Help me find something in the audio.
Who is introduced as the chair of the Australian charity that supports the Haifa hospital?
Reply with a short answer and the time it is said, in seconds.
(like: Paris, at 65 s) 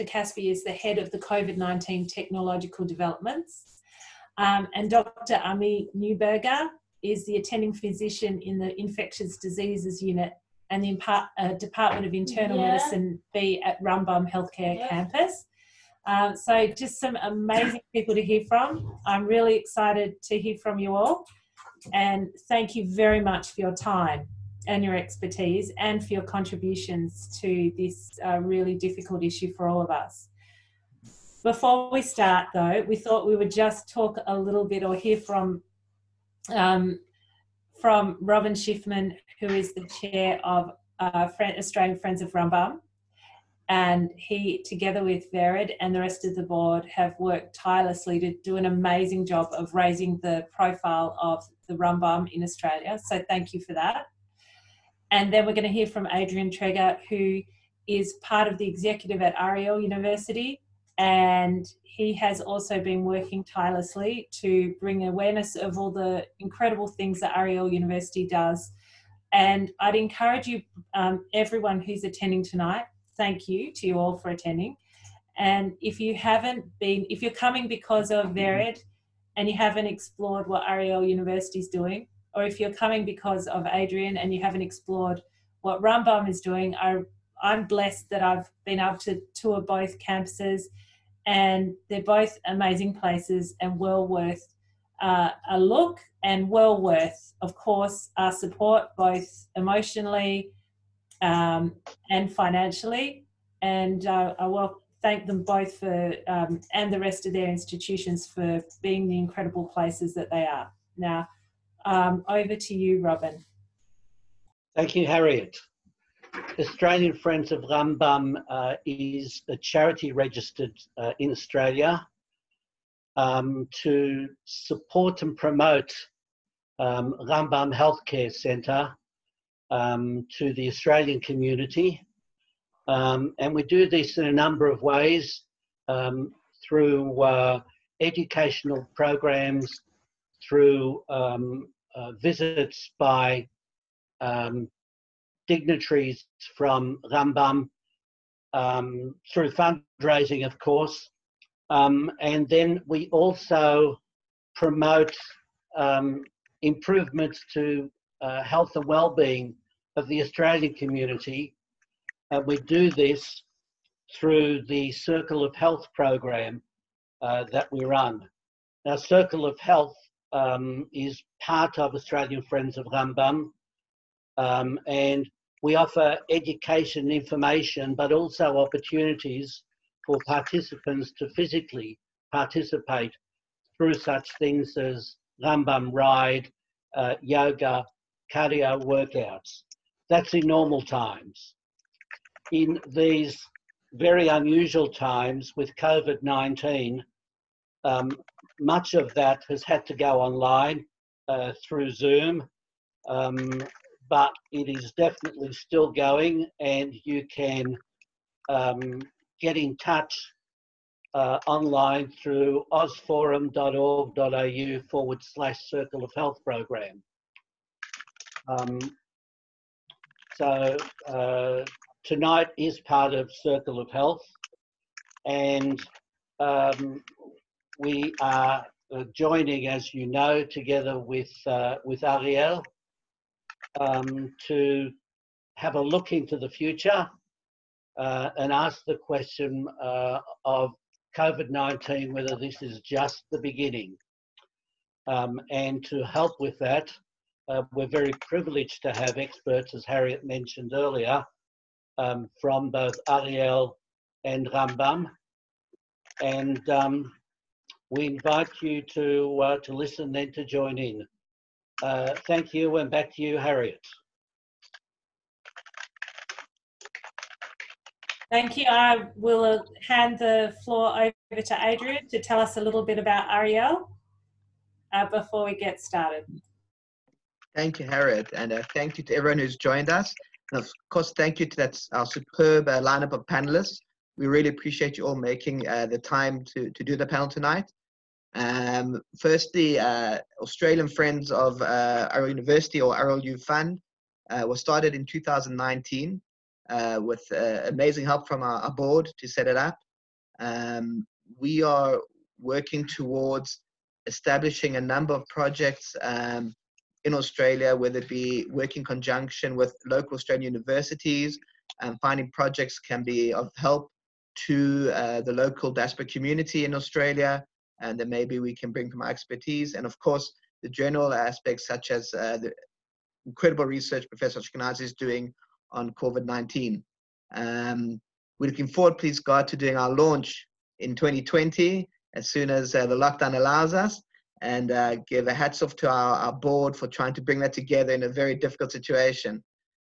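Robin Schiffman, at 38 s.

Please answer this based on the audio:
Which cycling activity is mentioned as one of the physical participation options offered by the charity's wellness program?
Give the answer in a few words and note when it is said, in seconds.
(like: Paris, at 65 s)
Rambam ride, at 185 s.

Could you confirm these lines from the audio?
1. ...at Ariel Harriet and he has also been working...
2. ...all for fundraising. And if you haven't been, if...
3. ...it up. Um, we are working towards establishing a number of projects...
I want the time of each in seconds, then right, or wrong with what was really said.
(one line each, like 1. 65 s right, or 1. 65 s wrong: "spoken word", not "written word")
1. 59 s wrong: "University", not "Harriet"
2. 73 s wrong: "attending", not "fundraising"
3. 299 s right.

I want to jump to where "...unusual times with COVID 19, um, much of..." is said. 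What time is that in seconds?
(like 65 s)
194 s.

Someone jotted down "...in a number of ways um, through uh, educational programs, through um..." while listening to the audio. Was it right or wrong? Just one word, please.
right.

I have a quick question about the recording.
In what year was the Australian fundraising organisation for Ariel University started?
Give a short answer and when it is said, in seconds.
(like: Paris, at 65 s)
2019, at 295 s.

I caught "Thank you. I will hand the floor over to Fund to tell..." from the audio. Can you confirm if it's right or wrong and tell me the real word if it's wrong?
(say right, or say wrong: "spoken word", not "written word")
wrong: "Adrian", not "Fund".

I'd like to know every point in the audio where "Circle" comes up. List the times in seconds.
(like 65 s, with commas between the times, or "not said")
164 s, 168 s, 215 s, 223 s.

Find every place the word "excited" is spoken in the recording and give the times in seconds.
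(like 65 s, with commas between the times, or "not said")
19 s.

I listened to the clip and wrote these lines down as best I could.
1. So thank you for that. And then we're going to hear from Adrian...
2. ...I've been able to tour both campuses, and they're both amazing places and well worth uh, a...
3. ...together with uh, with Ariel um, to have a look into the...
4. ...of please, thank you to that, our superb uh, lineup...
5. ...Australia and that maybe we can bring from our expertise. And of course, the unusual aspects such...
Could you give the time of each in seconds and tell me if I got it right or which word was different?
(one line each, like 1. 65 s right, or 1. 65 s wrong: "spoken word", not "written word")
1. 53 s right
2. 88 s right
3. 230 s right
4. 280 s wrong: "course", not "please"
5. 316 s wrong: "general", not "unusual".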